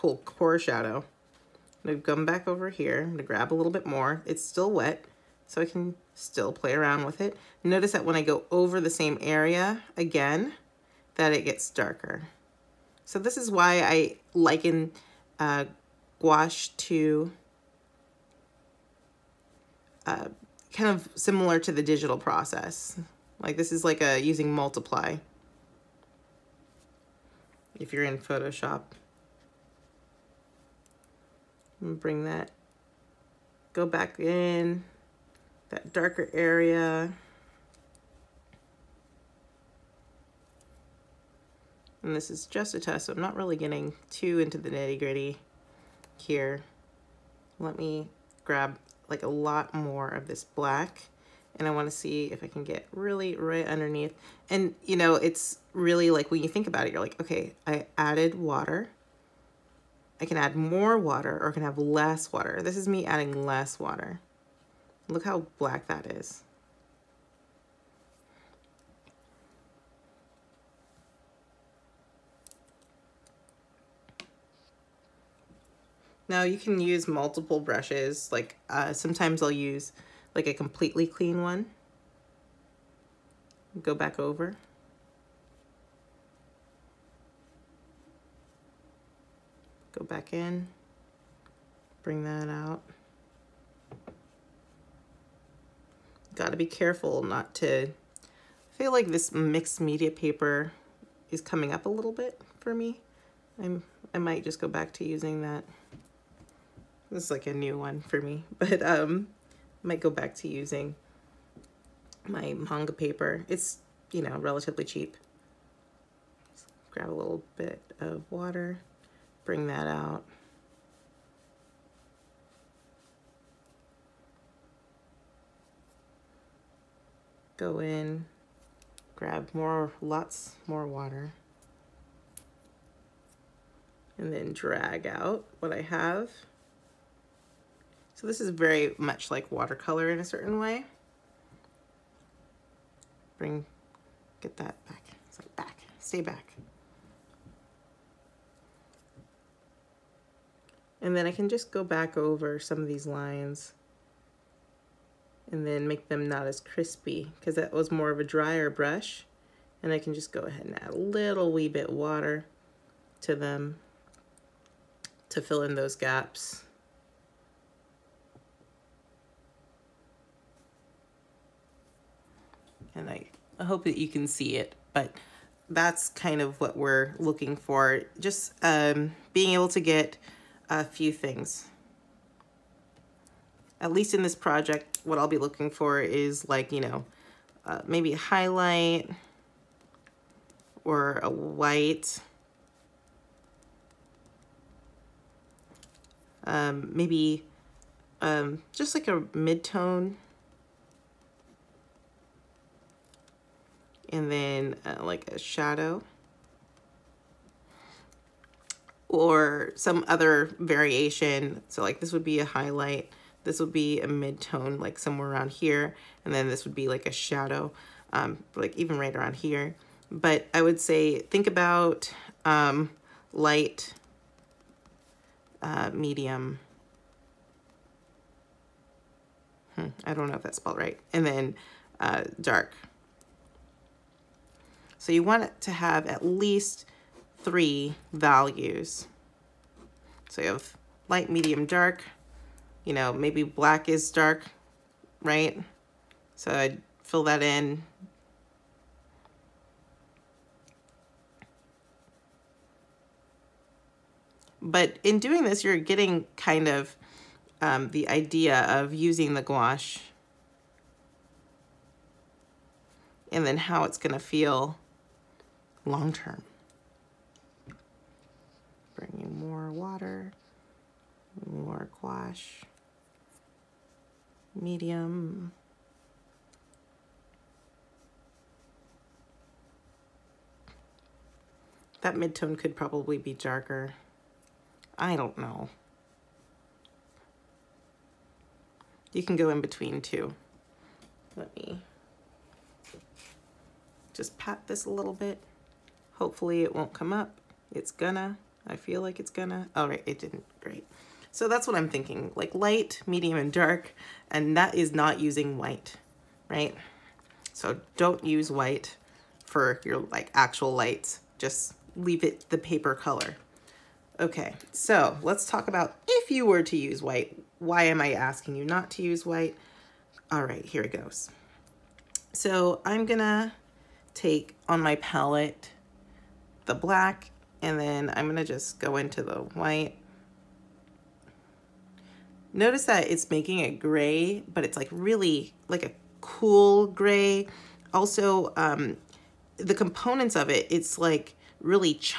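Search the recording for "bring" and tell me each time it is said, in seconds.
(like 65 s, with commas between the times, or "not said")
31 s, 92 s, 119 s, 143 s, 268 s.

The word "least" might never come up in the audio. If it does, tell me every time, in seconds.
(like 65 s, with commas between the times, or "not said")
183 s, 236 s.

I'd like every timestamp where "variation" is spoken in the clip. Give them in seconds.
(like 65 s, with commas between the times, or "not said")
210 s.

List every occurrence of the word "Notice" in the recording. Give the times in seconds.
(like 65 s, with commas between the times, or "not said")
7 s, 332 s.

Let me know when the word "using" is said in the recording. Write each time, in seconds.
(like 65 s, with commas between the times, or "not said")
24 s, 105 s, 110 s, 258 s, 305 s.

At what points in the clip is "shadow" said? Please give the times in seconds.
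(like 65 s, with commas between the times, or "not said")
0 s, 205 s, 217 s.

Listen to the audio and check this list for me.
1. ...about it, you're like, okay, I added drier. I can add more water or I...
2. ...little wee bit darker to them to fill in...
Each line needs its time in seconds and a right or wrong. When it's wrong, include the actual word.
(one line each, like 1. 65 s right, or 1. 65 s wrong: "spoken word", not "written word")
1. 56 s wrong: "water", not "drier"
2. 160 s wrong: "water", not "darker".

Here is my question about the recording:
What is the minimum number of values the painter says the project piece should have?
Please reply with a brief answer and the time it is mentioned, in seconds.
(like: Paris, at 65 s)
3, at 237 s.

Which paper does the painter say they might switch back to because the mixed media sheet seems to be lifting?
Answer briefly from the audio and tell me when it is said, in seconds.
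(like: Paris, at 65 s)
manga paper, at 112 s.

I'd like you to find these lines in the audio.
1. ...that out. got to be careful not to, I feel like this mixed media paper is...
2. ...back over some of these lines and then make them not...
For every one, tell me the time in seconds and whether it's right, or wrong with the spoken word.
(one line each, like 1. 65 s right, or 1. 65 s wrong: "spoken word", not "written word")
1. 92 s right
2. 151 s right.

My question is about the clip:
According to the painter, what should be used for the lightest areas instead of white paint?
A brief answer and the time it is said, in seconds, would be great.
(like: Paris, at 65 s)
the paper color, at 312 s.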